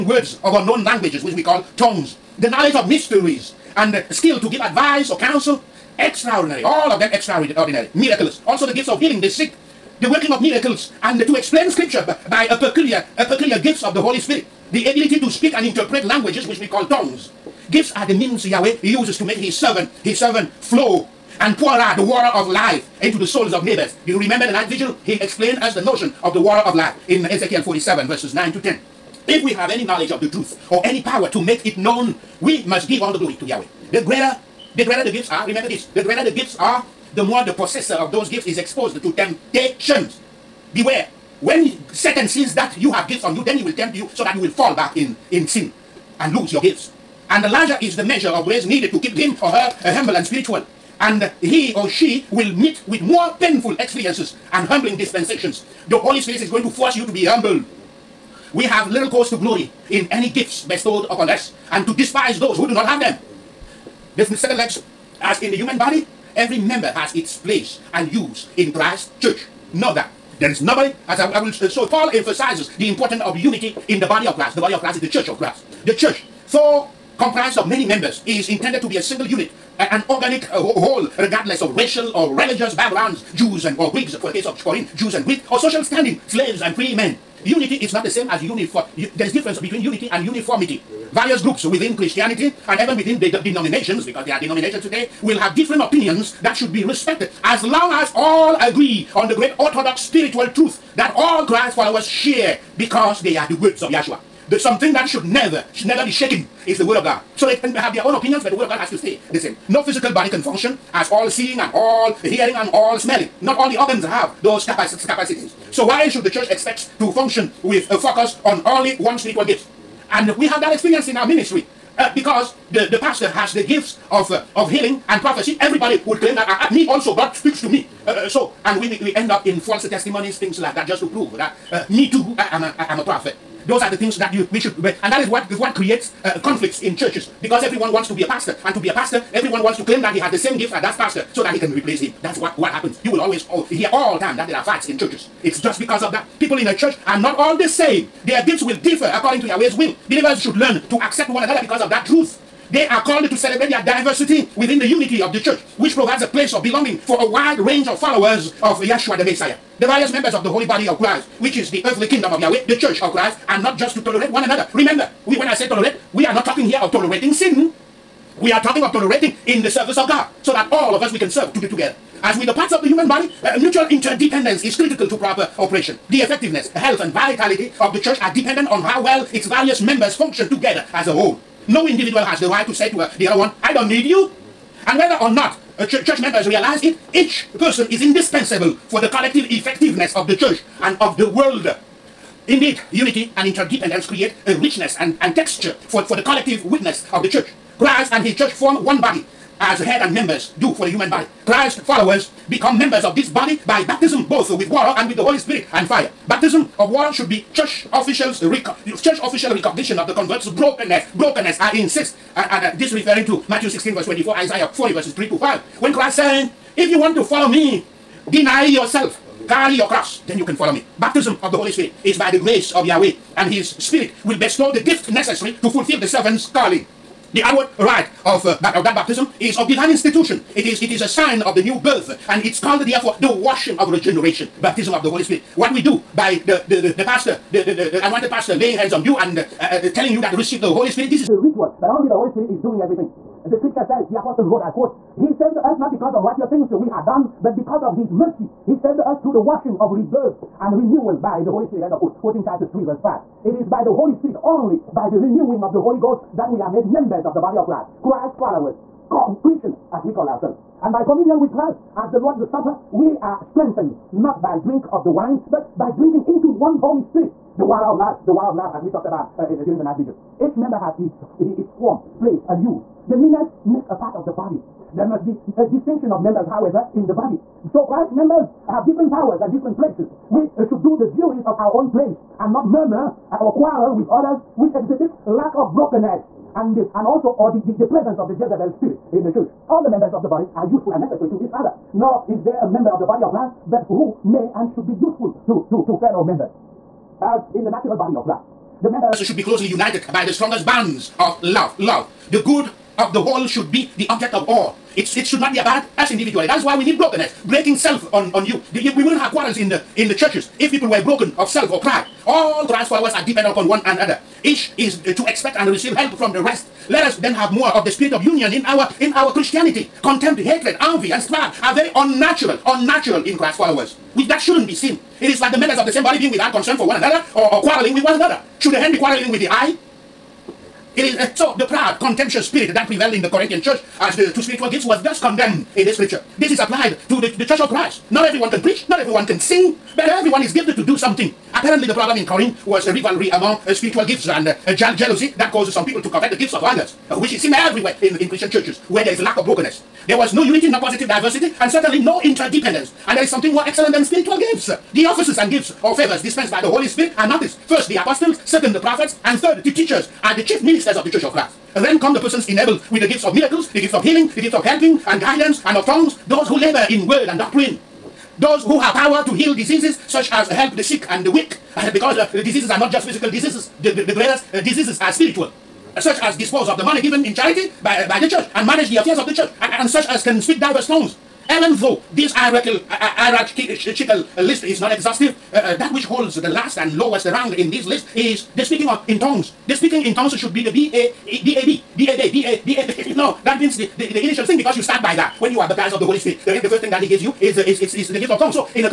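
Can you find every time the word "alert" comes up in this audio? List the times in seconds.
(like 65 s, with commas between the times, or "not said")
not said.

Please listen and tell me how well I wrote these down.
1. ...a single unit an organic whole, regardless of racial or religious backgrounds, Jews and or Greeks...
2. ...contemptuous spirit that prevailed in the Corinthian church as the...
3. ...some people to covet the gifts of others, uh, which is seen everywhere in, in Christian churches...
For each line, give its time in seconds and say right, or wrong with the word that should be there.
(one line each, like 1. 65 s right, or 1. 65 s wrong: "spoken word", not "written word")
1. 78 s right
2. 332 s right
3. 345 s right.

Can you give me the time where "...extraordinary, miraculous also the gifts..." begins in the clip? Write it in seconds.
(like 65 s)
7 s.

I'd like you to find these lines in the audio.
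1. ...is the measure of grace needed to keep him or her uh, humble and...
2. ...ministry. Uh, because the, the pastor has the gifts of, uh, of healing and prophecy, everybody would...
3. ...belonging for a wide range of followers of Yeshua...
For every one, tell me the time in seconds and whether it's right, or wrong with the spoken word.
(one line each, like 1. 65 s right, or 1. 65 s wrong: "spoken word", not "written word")
1. 47 s right
2. 121 s right
3. 156 s right.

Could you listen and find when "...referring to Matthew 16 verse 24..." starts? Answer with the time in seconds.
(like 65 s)
212 s.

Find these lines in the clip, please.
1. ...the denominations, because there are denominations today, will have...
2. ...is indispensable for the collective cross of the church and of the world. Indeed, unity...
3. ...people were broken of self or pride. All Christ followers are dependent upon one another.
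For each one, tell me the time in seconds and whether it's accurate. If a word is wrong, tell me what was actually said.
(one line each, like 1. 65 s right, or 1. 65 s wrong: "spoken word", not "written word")
1. 93 s right
2. 187 s wrong: "effectiveness", not "cross"
3. 310 s right.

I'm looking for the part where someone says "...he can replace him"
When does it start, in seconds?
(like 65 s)
141 s.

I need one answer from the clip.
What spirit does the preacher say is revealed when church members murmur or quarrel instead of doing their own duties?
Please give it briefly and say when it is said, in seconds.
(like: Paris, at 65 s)
Jezebel spirit, at 288 s.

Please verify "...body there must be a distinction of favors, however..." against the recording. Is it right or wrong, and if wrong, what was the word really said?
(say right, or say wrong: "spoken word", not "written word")
wrong: "members", not "favors".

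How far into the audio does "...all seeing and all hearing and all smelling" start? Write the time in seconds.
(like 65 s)
111 s.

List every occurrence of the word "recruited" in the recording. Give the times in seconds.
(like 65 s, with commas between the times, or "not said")
not said.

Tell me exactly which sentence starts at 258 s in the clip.
Christ followers, Christians, as we call ourselves.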